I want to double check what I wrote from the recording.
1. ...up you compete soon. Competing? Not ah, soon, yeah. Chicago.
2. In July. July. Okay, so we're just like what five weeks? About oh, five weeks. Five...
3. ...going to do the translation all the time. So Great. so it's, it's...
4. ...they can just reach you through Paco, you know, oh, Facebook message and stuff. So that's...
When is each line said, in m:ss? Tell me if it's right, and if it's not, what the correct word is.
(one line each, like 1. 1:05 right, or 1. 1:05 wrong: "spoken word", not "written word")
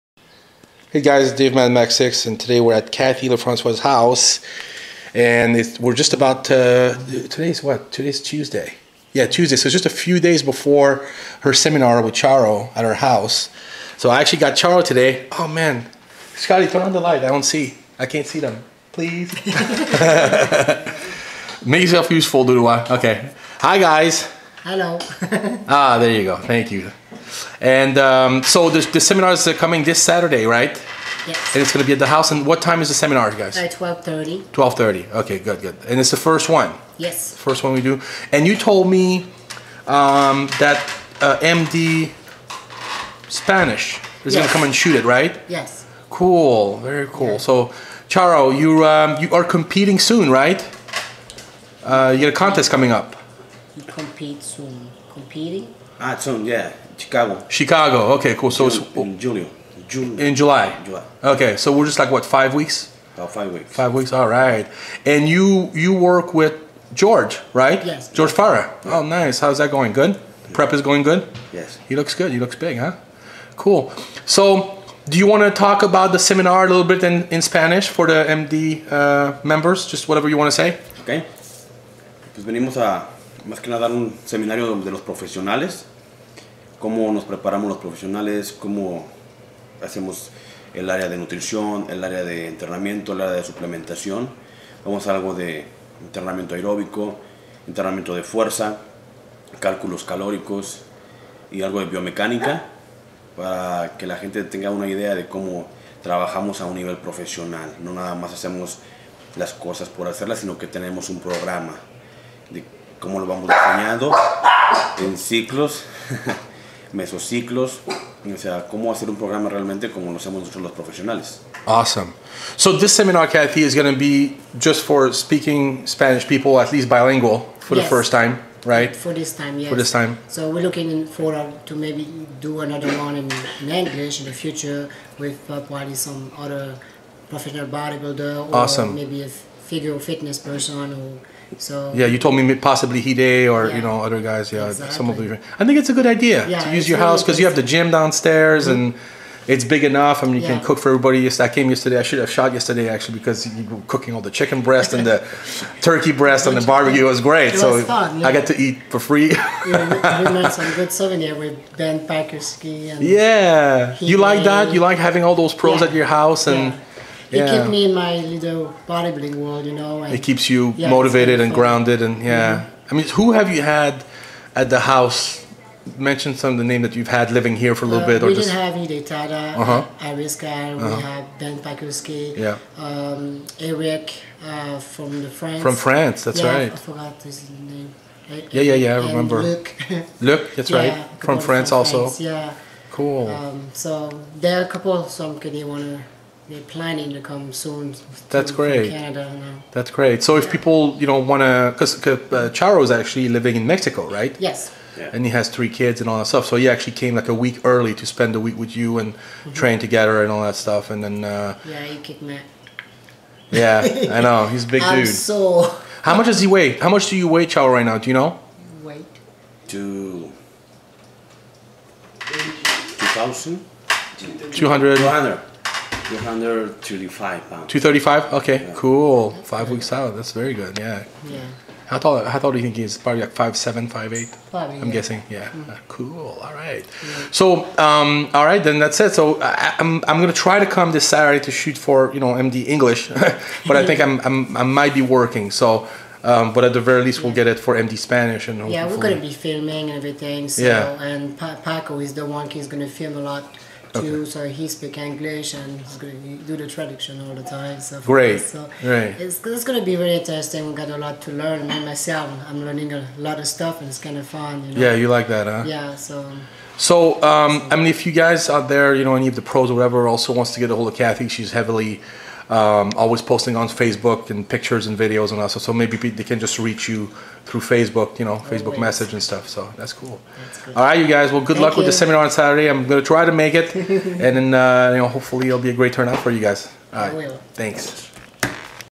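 1. 0:52 right
2. 1:00 right
3. 4:15 right
4. 4:35 wrong: "Facebook", not "Paco".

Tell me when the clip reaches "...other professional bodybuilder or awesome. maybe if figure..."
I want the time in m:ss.
2:16.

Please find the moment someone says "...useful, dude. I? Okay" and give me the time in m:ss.
0:22.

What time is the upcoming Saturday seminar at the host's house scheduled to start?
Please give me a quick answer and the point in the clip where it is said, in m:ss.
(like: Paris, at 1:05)
12:30, at 0:33.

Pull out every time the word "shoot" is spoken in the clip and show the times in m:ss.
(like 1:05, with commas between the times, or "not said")
0:44, 4:01.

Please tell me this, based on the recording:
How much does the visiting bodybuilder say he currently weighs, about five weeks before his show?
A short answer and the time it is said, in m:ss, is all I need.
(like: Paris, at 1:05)
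235 pounds, at 3:46.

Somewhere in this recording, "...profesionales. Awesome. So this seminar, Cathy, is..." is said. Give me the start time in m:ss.
2:00.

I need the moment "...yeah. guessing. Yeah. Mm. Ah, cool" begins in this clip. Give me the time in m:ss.
3:54.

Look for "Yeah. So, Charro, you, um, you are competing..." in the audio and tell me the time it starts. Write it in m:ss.
0:47.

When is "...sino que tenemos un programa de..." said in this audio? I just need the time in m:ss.
1:50.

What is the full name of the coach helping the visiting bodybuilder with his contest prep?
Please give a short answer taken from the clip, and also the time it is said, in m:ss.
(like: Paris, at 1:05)
George Farah, at 1:08.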